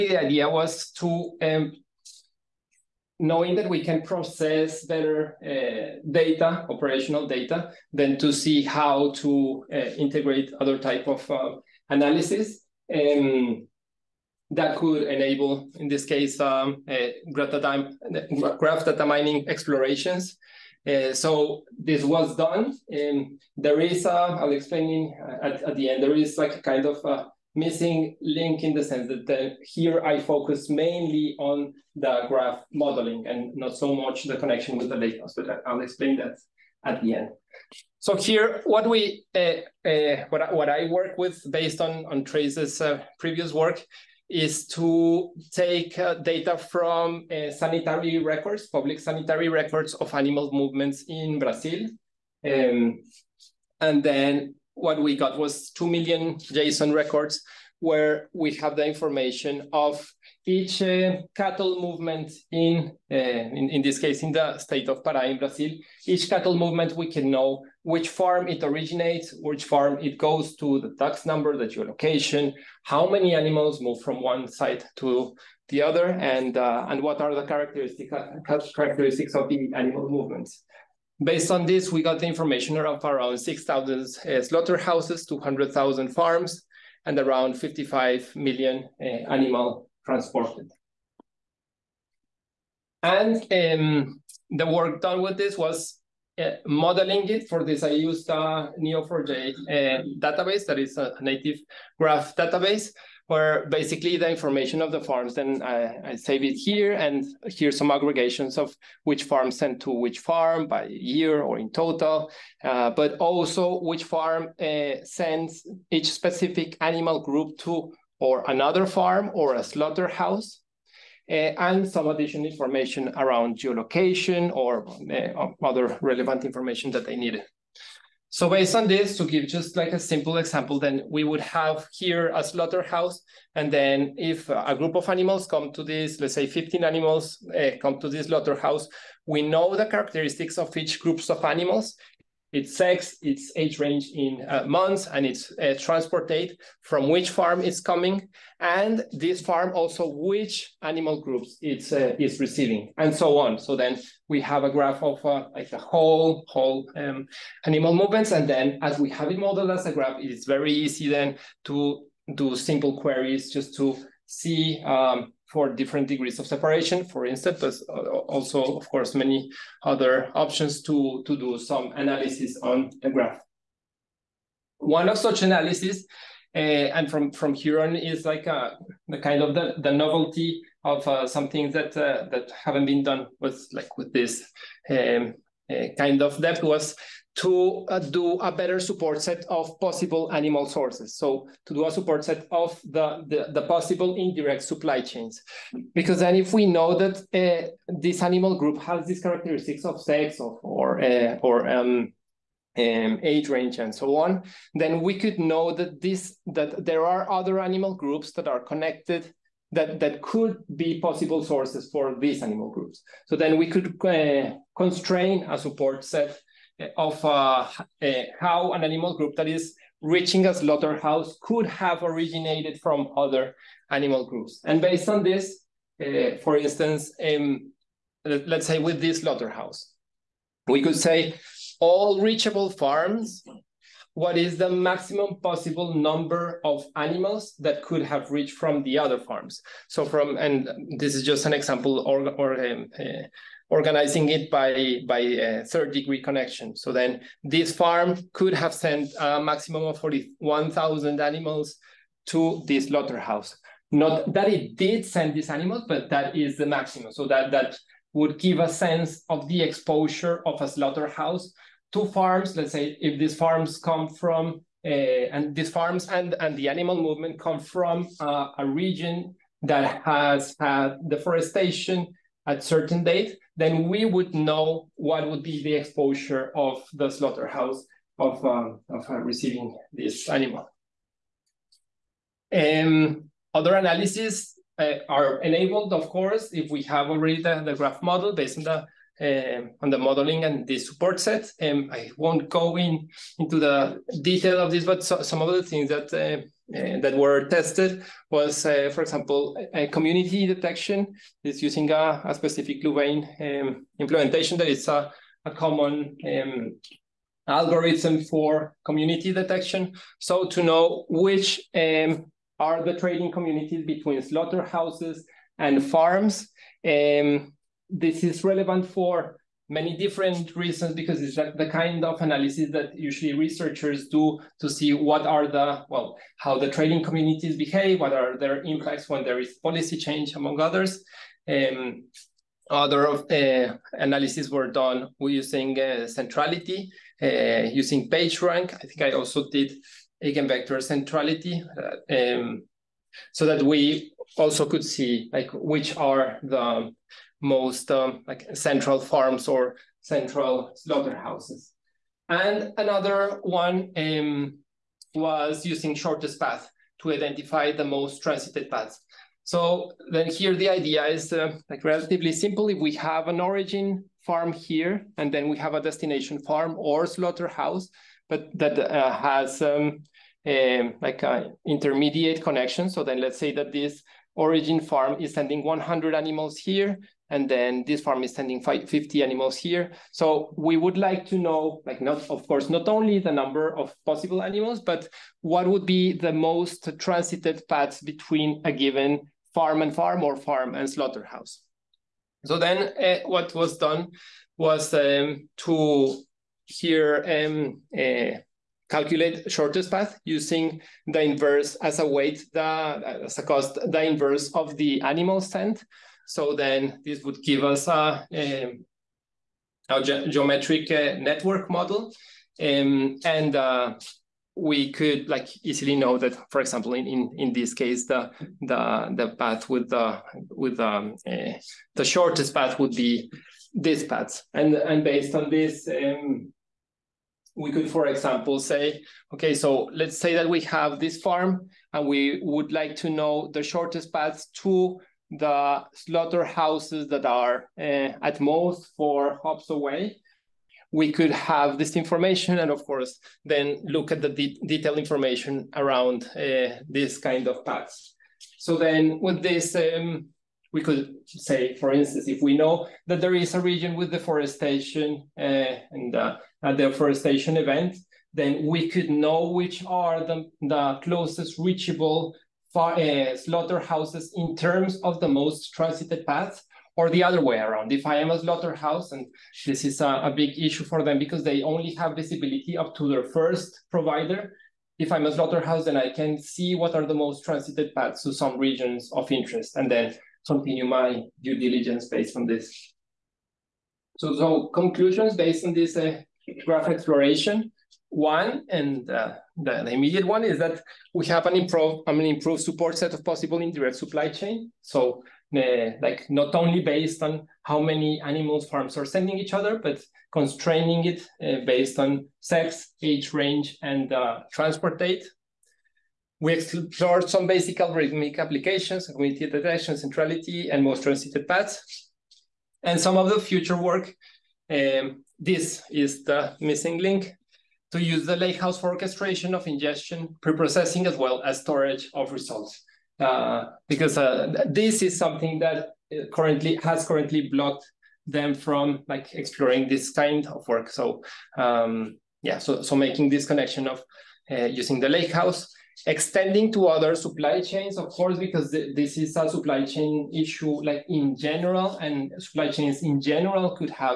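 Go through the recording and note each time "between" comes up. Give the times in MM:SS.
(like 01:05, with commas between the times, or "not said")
05:13, 06:28.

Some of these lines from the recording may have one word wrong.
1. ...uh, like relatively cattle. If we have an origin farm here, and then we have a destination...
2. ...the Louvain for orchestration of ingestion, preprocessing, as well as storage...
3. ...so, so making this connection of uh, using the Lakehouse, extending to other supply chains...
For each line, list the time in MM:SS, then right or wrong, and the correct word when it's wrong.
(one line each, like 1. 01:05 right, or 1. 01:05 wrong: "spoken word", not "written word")
1. 06:01 wrong: "simple", not "cattle"
2. 08:38 wrong: "Lakehouse", not "Louvain"
3. 08:52 right.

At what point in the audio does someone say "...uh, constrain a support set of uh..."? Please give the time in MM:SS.
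03:34.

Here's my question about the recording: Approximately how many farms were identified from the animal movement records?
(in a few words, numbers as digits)
200,000.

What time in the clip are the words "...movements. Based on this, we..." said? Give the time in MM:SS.
01:20.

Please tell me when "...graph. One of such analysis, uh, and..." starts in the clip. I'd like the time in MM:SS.
02:53.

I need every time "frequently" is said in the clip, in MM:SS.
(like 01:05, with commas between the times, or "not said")
not said.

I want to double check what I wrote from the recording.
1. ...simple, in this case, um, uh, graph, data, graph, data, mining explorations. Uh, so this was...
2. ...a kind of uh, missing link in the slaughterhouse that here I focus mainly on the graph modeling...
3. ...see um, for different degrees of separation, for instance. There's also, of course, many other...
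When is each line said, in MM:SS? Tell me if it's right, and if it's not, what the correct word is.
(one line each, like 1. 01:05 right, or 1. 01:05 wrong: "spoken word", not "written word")
1. 00:15 wrong: "enable", not "simple"
2. 00:26 wrong: "sense", not "slaughterhouse"
3. 02:44 right.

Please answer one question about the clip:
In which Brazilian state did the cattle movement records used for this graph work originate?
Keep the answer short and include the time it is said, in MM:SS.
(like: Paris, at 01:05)
Pará, at 01:05.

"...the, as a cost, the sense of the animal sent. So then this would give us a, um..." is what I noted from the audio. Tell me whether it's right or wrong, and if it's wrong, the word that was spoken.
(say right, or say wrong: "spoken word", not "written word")
wrong: "inverse", not "sense".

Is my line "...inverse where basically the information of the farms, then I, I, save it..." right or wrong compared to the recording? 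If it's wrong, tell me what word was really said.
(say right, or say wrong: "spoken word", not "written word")
wrong: "database", not "inverse".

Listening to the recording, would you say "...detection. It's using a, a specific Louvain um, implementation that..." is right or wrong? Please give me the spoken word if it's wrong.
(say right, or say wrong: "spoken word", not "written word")
right.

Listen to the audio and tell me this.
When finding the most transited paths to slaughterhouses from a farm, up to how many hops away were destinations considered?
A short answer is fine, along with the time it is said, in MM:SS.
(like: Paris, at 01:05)
4, at 07:18.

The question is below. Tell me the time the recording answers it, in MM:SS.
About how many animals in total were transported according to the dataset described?
01:27.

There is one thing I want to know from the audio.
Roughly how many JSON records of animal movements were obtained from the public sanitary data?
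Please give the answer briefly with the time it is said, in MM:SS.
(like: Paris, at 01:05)
2 million, at 00:55.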